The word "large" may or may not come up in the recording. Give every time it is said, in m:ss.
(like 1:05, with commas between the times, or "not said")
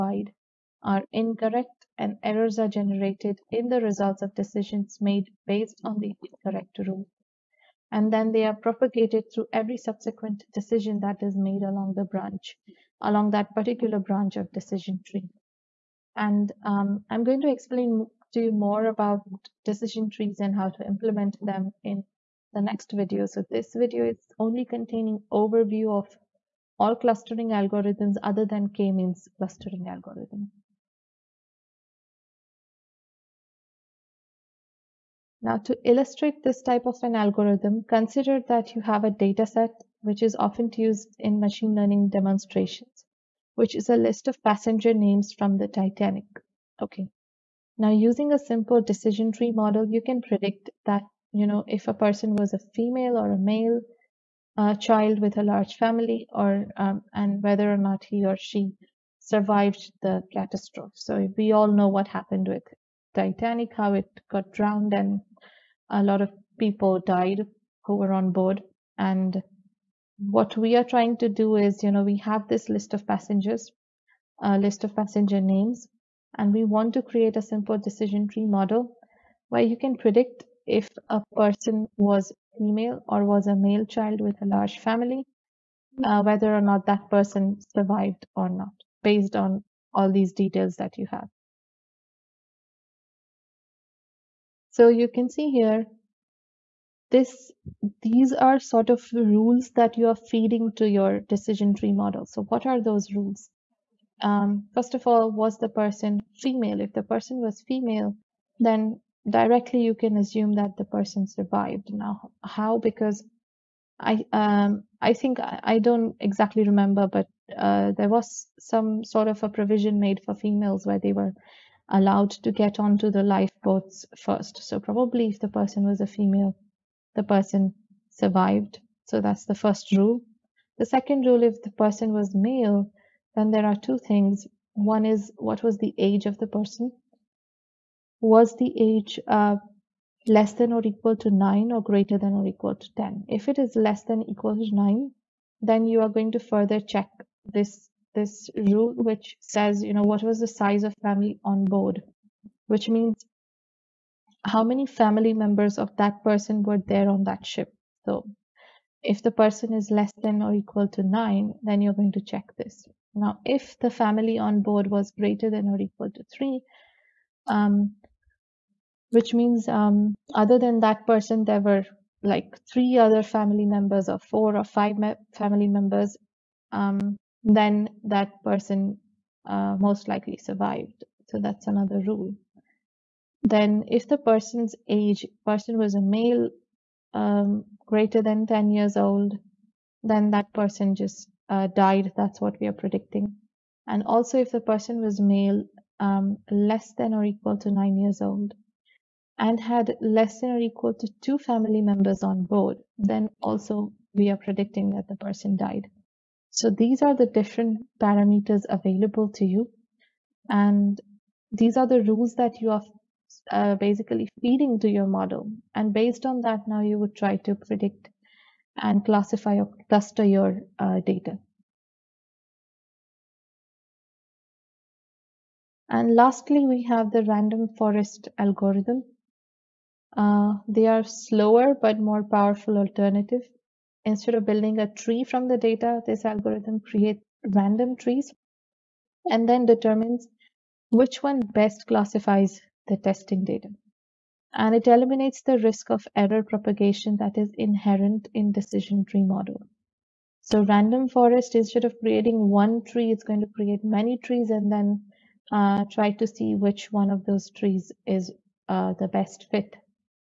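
0:55, 1:24.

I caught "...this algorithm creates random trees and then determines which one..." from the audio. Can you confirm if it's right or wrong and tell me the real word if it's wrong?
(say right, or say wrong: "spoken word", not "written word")
right.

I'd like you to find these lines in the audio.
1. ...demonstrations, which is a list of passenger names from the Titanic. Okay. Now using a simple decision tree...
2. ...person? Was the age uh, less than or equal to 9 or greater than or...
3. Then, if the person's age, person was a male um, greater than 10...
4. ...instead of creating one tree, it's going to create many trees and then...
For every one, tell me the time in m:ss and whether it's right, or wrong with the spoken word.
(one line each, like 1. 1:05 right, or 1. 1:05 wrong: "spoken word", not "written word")
1. 0:42 right
2. 2:16 right
3. 3:03 right
4. 4:11 right.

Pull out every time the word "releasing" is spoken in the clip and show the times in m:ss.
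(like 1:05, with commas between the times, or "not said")
not said.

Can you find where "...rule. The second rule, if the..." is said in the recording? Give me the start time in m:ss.
2:09.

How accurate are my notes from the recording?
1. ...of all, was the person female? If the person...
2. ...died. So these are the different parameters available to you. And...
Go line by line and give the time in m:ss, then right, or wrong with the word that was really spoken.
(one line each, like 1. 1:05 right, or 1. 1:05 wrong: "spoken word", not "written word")
1. 1:44 right
2. 3:25 right.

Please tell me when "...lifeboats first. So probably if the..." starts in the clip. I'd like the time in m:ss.
2:03.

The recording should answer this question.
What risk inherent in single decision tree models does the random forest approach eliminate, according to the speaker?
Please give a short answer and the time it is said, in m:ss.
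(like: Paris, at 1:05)
Error propagation, at 4:06.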